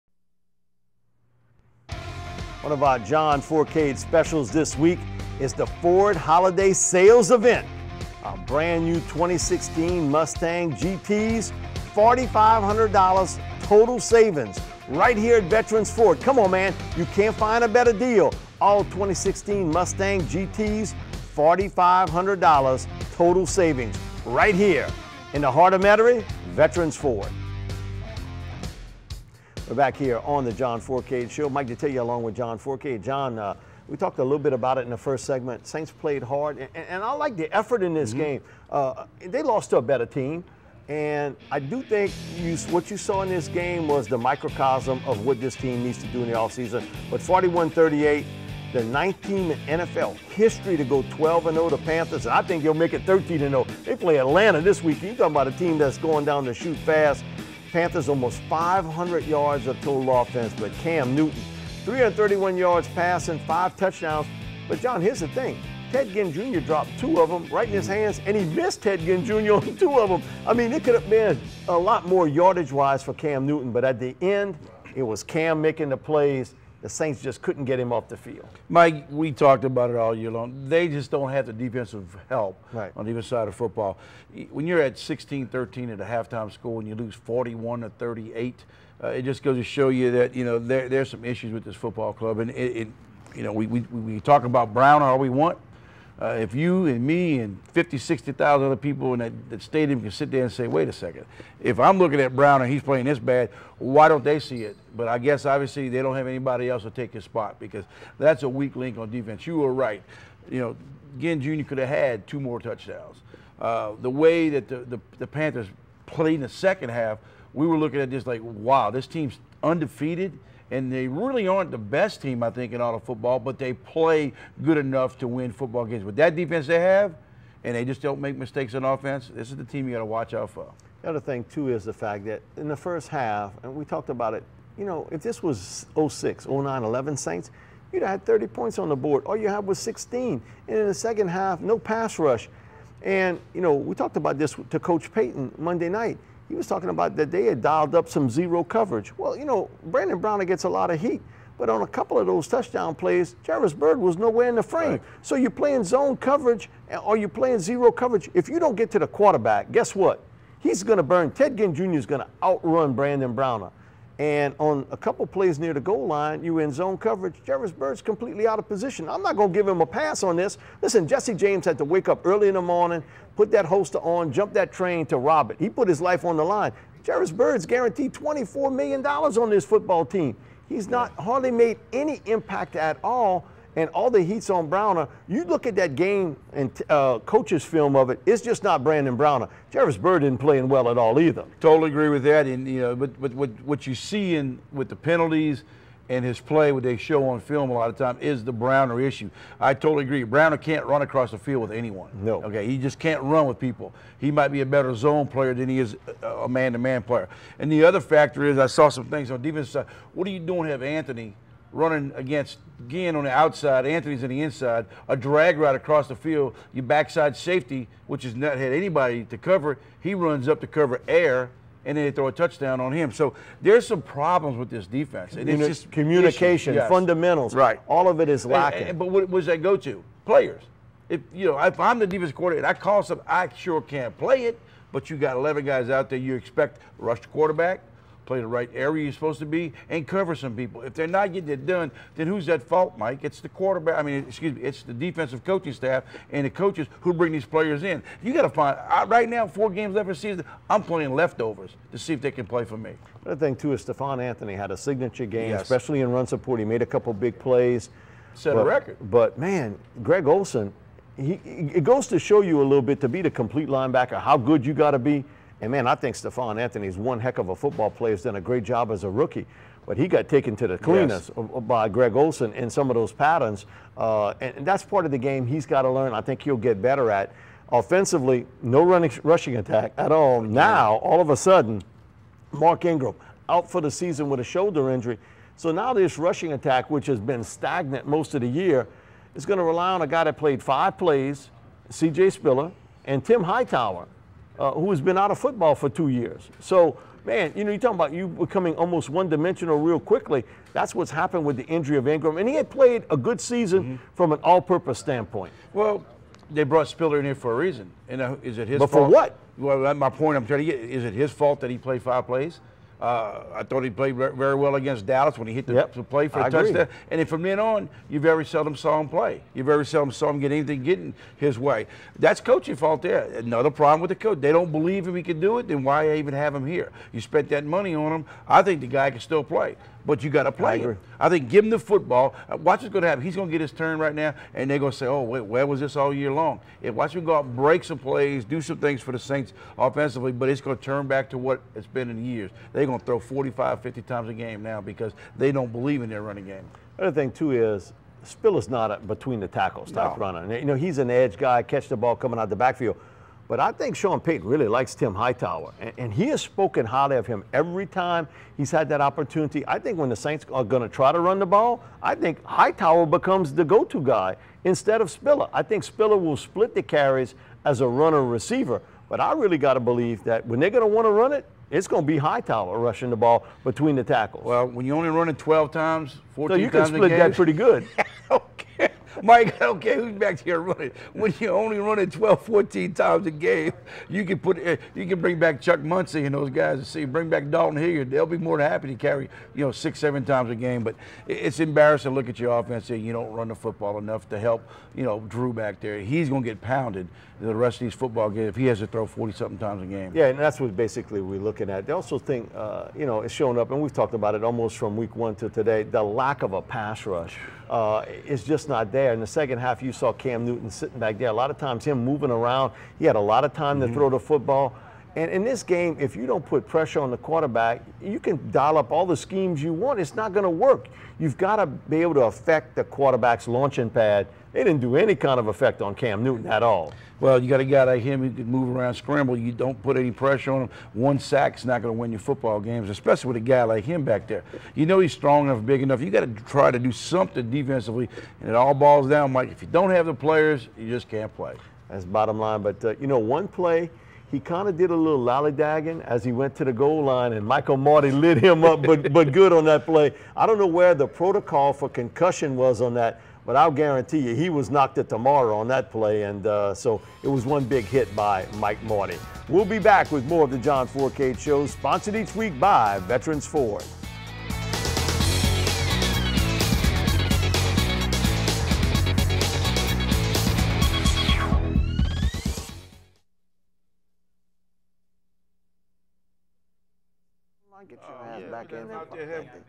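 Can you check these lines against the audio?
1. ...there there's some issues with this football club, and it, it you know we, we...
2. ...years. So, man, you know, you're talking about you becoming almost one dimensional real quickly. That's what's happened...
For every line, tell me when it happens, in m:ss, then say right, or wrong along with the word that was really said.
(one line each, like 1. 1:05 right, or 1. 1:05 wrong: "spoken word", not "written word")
1. 1:30 right
2. 4:56 right.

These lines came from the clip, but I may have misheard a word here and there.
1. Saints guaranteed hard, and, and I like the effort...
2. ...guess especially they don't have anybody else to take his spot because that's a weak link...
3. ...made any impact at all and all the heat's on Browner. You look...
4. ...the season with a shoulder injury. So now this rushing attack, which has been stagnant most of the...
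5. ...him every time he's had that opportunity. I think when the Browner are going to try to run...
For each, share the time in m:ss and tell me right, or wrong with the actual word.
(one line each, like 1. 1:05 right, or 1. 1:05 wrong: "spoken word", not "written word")
1. 0:35 wrong: "played", not "guaranteed"
2. 1:45 wrong: "obviously", not "especially"
3. 3:01 right
4. 4:43 right
5. 5:57 wrong: "Saints", not "Browner".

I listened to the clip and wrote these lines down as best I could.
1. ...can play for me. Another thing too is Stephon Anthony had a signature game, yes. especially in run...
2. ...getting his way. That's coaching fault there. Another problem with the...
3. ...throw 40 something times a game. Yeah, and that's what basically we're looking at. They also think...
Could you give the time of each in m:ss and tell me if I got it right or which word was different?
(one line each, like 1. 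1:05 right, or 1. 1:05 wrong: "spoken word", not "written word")
1. 4:12 right
2. 5:20 right
3. 6:38 right.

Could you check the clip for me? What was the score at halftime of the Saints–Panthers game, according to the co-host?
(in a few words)
16-13.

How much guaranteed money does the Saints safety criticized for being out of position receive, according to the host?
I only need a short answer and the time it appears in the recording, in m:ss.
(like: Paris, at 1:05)
$24 million, at 2:58.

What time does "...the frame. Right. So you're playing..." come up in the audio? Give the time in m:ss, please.
2:34.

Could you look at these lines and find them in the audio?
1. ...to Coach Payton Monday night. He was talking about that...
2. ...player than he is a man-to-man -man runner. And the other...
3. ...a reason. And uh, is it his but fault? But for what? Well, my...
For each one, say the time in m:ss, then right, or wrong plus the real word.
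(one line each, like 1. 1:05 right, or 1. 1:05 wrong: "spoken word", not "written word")
1. 2:24 right
2. 3:25 wrong: "player", not "runner"
3. 5:07 right.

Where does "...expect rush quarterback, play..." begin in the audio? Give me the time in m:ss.
3:56.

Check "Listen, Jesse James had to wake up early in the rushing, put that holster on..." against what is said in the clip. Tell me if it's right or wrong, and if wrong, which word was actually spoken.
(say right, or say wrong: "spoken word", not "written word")
wrong: "morning", not "rushing".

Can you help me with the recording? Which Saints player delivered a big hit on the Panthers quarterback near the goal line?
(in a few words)
Michael Mauti.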